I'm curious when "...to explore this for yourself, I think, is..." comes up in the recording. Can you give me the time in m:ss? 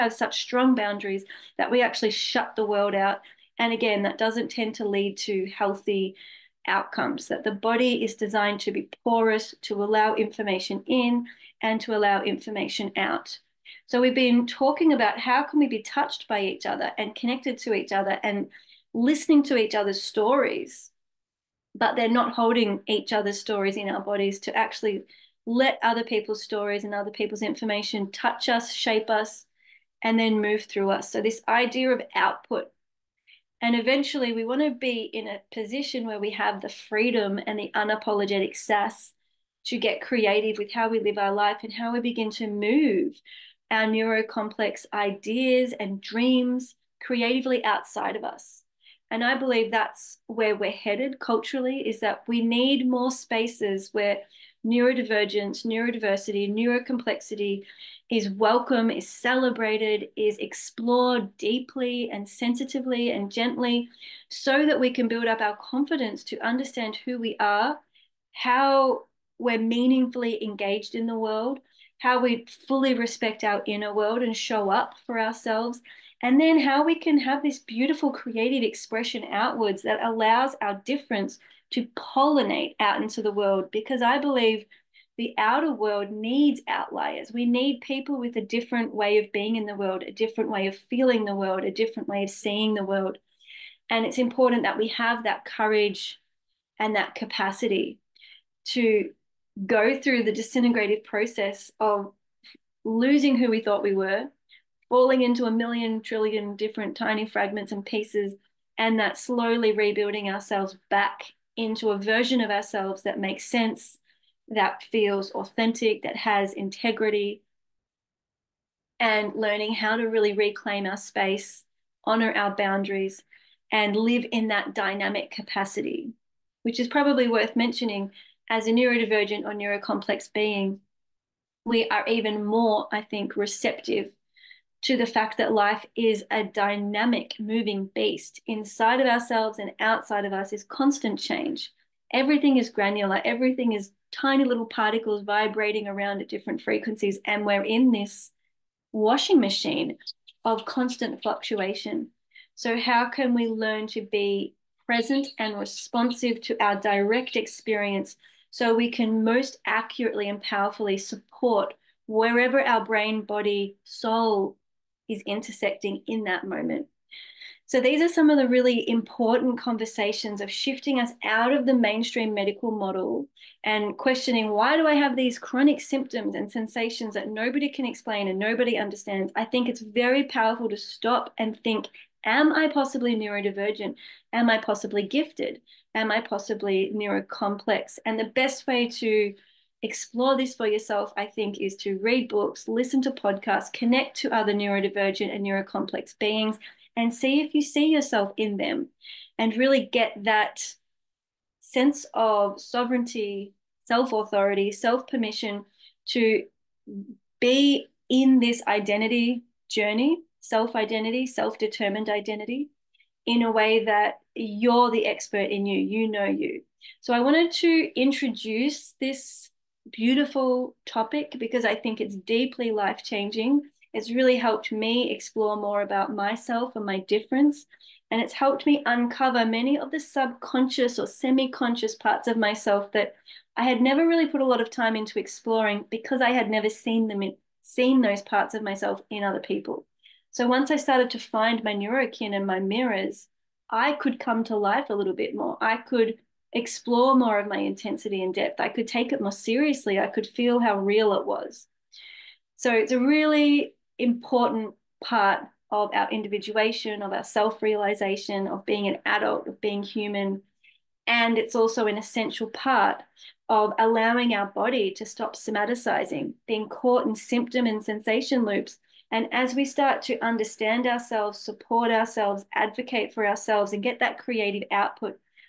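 3:08.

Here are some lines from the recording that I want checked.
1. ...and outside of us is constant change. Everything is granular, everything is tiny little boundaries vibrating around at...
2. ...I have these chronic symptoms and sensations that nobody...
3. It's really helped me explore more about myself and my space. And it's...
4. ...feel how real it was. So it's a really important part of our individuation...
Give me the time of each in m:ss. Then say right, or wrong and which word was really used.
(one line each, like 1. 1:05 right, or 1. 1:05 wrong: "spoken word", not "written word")
1. 2:19 wrong: "particles", not "boundaries"
2. 2:54 right
3. 3:43 wrong: "difference", not "space"
4. 4:10 right.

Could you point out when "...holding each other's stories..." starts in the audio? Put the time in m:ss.
0:22.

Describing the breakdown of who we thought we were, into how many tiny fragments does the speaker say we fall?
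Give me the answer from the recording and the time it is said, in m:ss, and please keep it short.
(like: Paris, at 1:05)
a million trillion, at 1:45.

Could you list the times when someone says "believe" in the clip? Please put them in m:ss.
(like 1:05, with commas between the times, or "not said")
0:49, 1:24.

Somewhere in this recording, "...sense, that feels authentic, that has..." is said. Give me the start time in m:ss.
1:53.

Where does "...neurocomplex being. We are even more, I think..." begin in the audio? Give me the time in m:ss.
2:09.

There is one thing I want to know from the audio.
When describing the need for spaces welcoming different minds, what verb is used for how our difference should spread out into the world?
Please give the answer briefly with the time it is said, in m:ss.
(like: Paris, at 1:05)
pollinate, at 1:21.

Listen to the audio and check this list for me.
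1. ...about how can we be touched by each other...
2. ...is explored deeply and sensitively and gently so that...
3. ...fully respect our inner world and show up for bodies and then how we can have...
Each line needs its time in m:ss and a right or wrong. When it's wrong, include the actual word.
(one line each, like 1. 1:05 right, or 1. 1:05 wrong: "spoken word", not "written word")
1. 0:14 right
2. 1:00 right
3. 1:12 wrong: "ourselves", not "bodies".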